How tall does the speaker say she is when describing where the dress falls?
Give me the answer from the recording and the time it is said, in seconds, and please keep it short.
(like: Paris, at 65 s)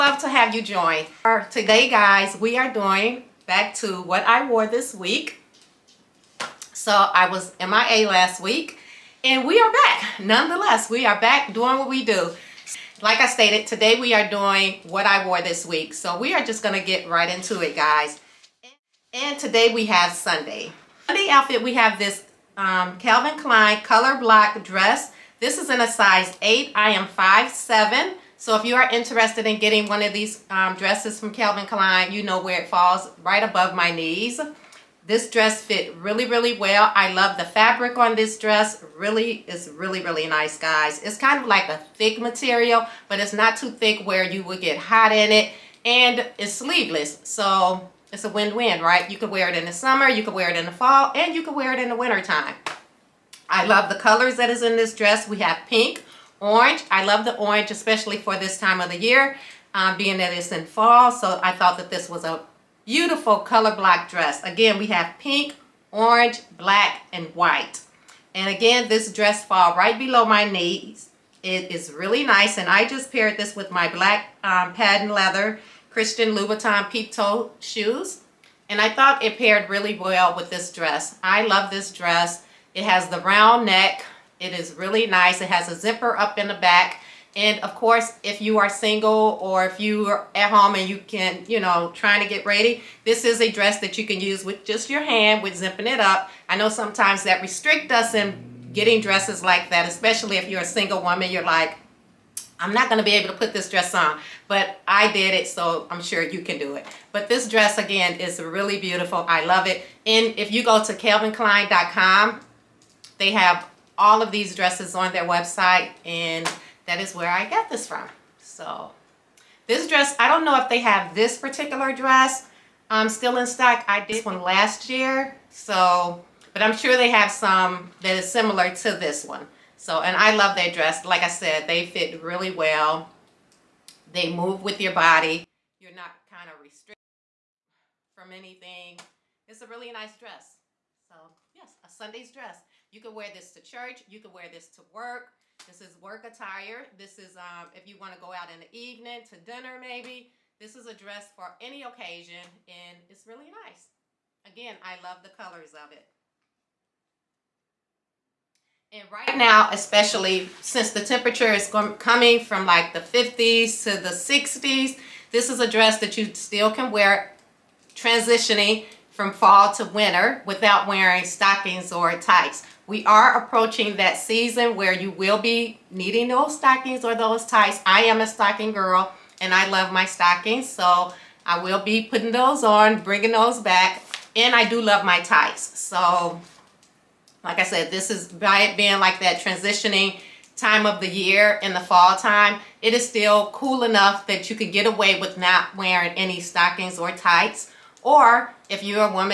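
5'7", at 27 s.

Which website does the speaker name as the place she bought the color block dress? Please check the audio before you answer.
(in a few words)
calvinklein.com.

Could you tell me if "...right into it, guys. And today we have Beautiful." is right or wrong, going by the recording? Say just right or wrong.
wrong.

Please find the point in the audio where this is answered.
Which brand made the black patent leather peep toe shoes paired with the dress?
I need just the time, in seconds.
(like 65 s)
75 s.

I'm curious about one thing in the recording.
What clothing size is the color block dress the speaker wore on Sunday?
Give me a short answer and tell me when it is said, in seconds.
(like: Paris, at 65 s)
8, at 25 s.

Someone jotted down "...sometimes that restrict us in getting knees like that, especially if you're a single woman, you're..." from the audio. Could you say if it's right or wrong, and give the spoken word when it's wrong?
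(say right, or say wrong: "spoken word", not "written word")
wrong: "dresses", not "knees".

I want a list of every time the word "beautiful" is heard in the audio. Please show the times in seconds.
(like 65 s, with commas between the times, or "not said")
62 s, 108 s.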